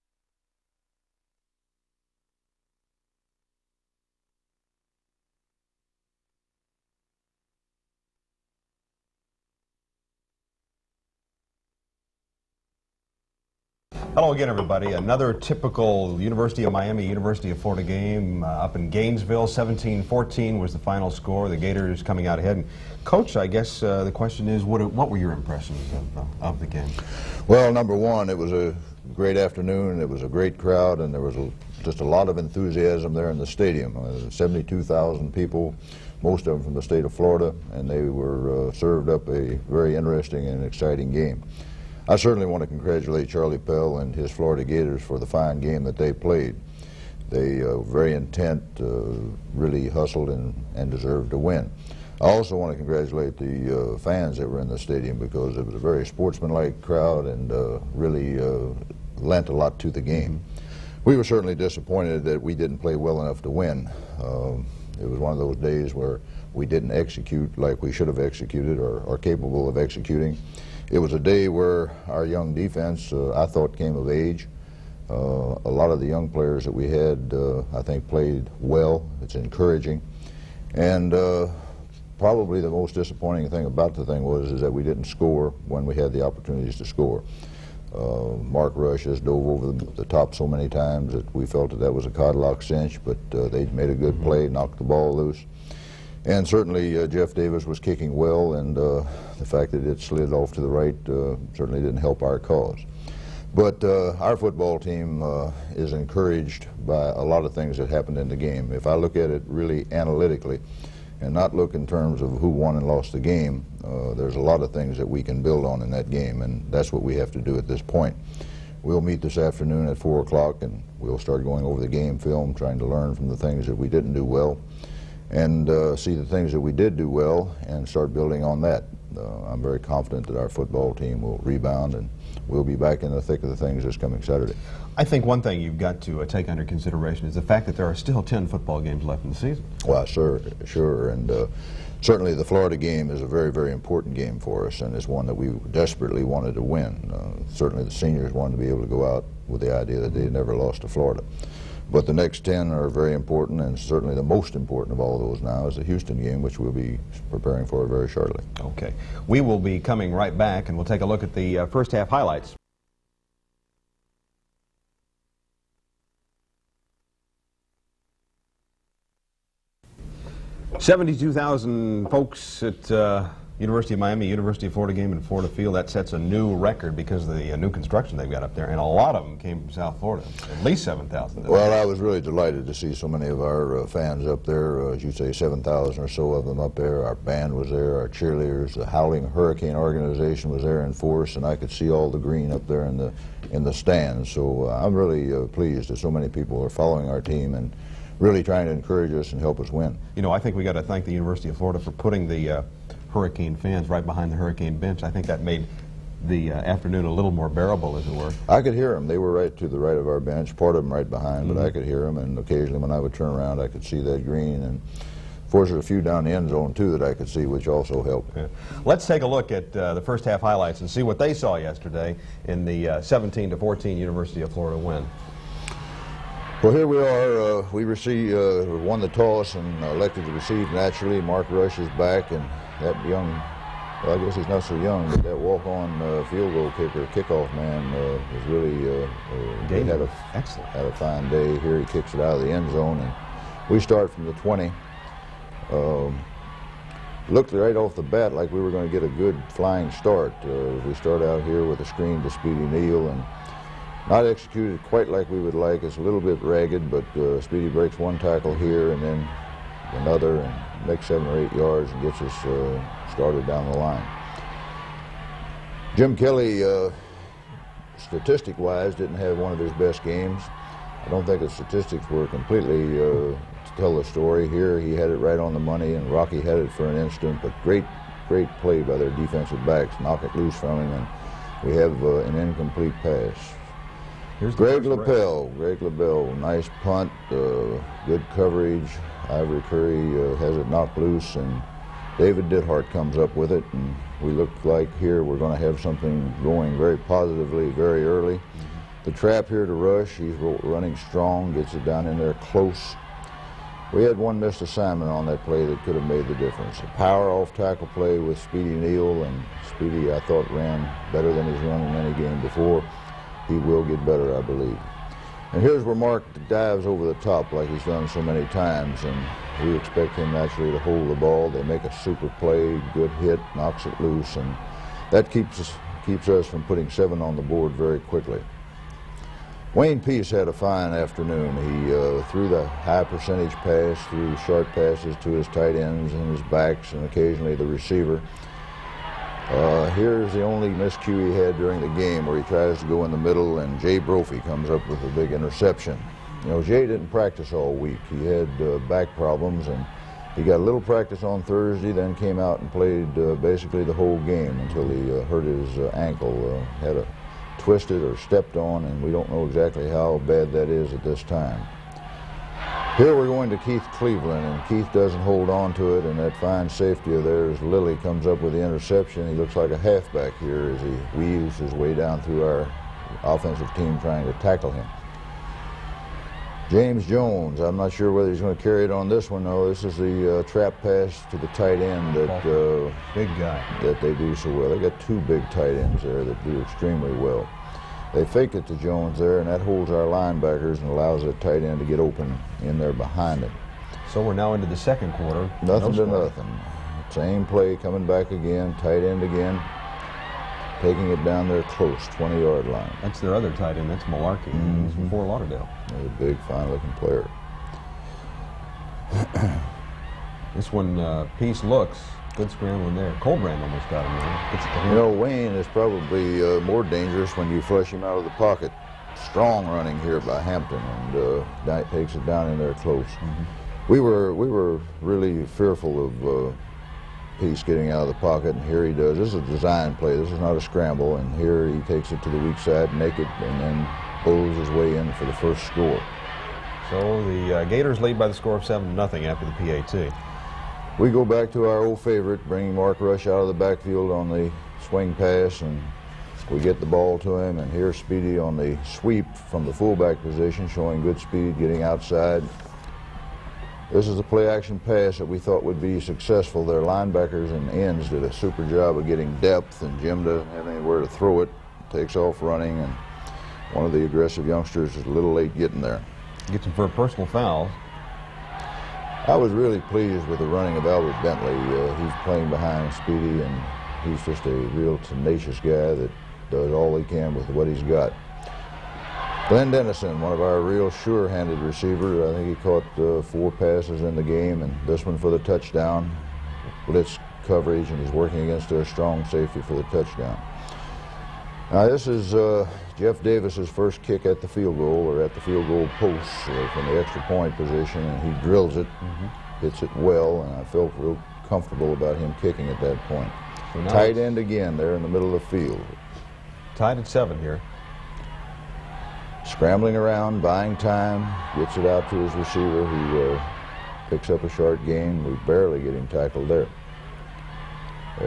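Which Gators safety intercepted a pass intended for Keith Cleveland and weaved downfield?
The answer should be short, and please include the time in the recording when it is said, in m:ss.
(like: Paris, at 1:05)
Lilly, at 6:07.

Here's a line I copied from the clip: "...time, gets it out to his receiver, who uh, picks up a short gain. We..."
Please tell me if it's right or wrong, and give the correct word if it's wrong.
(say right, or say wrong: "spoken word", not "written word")
right.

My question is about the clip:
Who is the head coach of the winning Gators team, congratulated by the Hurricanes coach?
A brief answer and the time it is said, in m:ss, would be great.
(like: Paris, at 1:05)
Charlie Pell, at 0:43.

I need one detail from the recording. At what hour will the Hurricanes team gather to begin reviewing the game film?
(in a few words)
4 o'clock.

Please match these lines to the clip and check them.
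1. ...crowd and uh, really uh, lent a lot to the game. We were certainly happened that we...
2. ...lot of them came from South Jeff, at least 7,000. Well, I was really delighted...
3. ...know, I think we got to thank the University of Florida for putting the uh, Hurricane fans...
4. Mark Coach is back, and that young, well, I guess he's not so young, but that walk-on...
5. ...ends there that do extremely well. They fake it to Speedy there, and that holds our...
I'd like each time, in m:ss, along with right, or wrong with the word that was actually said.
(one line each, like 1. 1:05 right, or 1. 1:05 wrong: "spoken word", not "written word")
1. 0:56 wrong: "disappointed", not "happened"
2. 2:58 wrong: "Florida", not "Jeff"
3. 3:20 right
4. 3:51 wrong: "Rush", not "Coach"
5. 6:25 wrong: "Jones", not "Speedy".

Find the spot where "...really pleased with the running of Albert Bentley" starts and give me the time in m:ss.
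7:49.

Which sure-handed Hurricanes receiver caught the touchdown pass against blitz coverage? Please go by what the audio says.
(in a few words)
Glenn Dennison.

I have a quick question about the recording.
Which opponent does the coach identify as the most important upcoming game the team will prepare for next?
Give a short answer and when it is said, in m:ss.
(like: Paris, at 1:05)
Houston, at 2:35.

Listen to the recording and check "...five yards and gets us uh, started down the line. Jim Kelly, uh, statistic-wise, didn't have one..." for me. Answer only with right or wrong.
wrong.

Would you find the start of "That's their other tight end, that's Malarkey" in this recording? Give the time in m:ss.
6:43.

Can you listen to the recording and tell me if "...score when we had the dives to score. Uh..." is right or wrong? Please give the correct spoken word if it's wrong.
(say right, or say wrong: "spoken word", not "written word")
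wrong: "opportunities", not "dives".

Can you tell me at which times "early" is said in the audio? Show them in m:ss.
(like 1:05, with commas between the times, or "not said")
4:58.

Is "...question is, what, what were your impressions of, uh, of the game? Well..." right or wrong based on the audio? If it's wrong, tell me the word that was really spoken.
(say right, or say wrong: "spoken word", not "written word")
right.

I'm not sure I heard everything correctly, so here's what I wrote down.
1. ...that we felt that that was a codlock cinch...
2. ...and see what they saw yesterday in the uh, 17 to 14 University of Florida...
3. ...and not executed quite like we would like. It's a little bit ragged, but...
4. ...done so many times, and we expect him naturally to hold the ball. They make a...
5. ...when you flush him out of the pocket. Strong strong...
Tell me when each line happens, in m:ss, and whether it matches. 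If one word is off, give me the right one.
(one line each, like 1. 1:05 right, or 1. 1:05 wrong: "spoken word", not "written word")
1. 1:31 right
2. 3:40 right
3. 4:13 right
4. 5:17 right
5. 6:57 wrong: "running", not "strong".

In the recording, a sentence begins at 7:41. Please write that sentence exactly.
Takes off running, and one of the aggressive youngsters is a little late getting there.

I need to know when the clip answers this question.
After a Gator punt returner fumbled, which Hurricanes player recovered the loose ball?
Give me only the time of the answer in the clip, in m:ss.
4:52.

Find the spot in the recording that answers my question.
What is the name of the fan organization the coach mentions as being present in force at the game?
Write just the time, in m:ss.
3:08.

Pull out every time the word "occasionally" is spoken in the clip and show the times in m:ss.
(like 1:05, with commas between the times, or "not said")
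3:32, 5:37.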